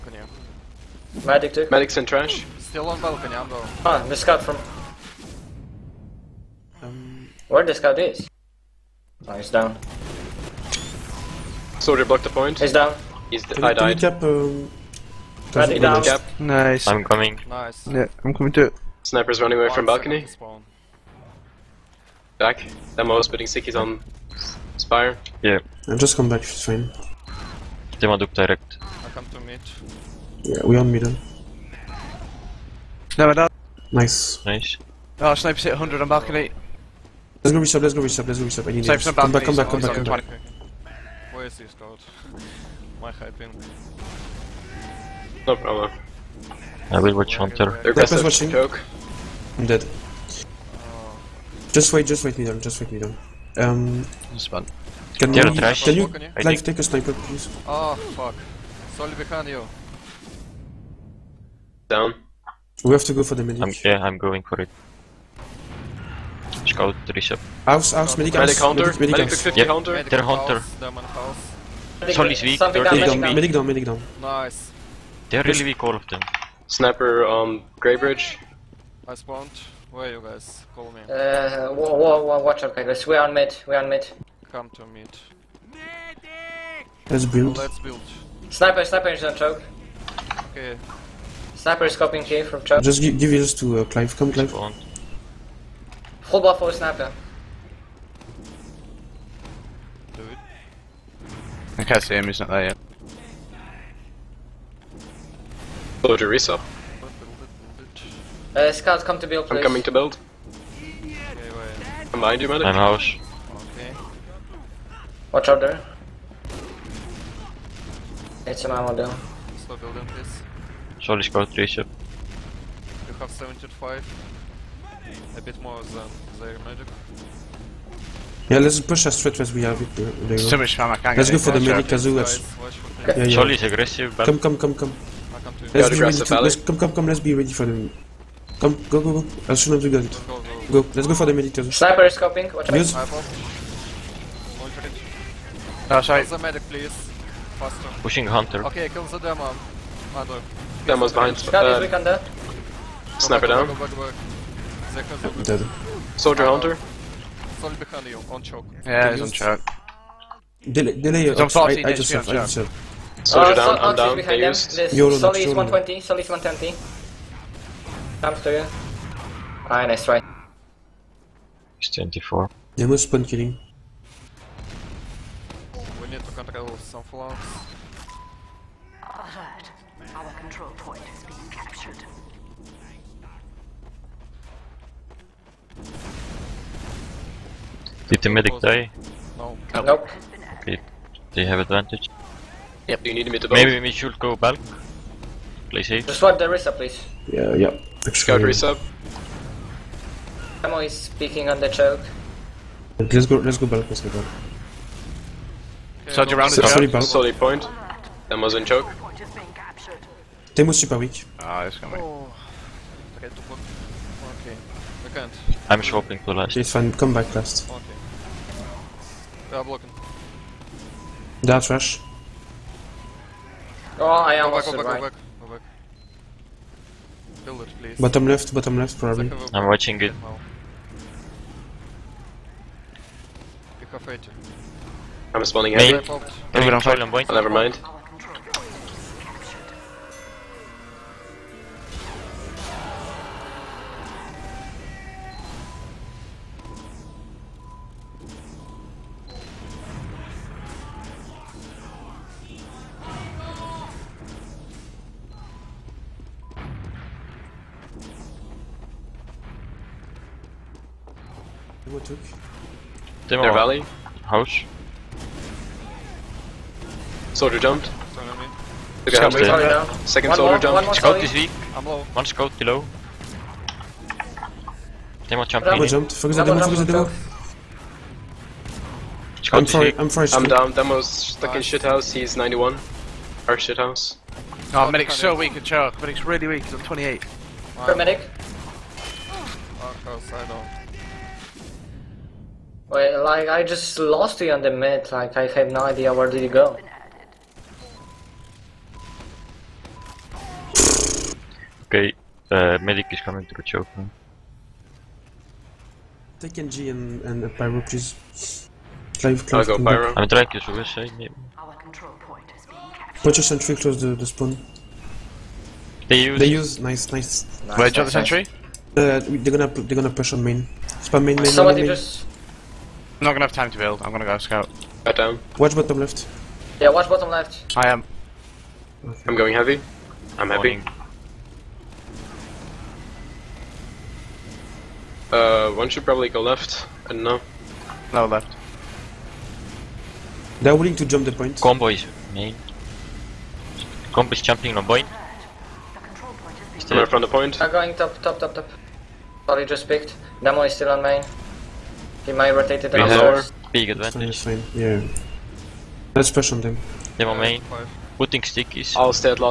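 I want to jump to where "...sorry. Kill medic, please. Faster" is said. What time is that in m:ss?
2:26.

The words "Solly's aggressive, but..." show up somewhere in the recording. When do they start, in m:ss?
2:13.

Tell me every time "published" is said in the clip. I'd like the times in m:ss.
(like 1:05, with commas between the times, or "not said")
not said.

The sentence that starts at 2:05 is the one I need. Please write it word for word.
A bit more than their magic.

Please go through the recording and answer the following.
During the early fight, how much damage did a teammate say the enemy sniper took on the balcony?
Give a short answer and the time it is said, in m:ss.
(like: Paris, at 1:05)
100, at 0:35.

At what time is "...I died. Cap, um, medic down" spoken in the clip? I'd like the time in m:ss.
0:13.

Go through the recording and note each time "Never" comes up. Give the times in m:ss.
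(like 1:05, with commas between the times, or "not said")
0:33, 3:56.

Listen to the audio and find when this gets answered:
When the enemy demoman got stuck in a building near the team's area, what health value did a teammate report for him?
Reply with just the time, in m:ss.
4:42.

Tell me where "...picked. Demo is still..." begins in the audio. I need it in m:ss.
5:49.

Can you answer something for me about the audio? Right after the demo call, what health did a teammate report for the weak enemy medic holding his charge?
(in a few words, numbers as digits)
28.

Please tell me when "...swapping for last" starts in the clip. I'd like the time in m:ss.
3:35.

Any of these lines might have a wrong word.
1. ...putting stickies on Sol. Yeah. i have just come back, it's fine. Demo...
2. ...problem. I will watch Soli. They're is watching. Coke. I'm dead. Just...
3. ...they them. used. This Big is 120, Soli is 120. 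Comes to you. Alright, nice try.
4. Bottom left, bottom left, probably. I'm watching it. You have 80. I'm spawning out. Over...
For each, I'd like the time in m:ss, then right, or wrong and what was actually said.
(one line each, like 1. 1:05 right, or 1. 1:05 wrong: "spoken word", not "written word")
1. 0:23 wrong: "Spire", not "Sol"
2. 0:45 wrong: "Hunter", not "Soli"
3. 2:44 wrong: "Soli", not "Big"
4. 3:47 right.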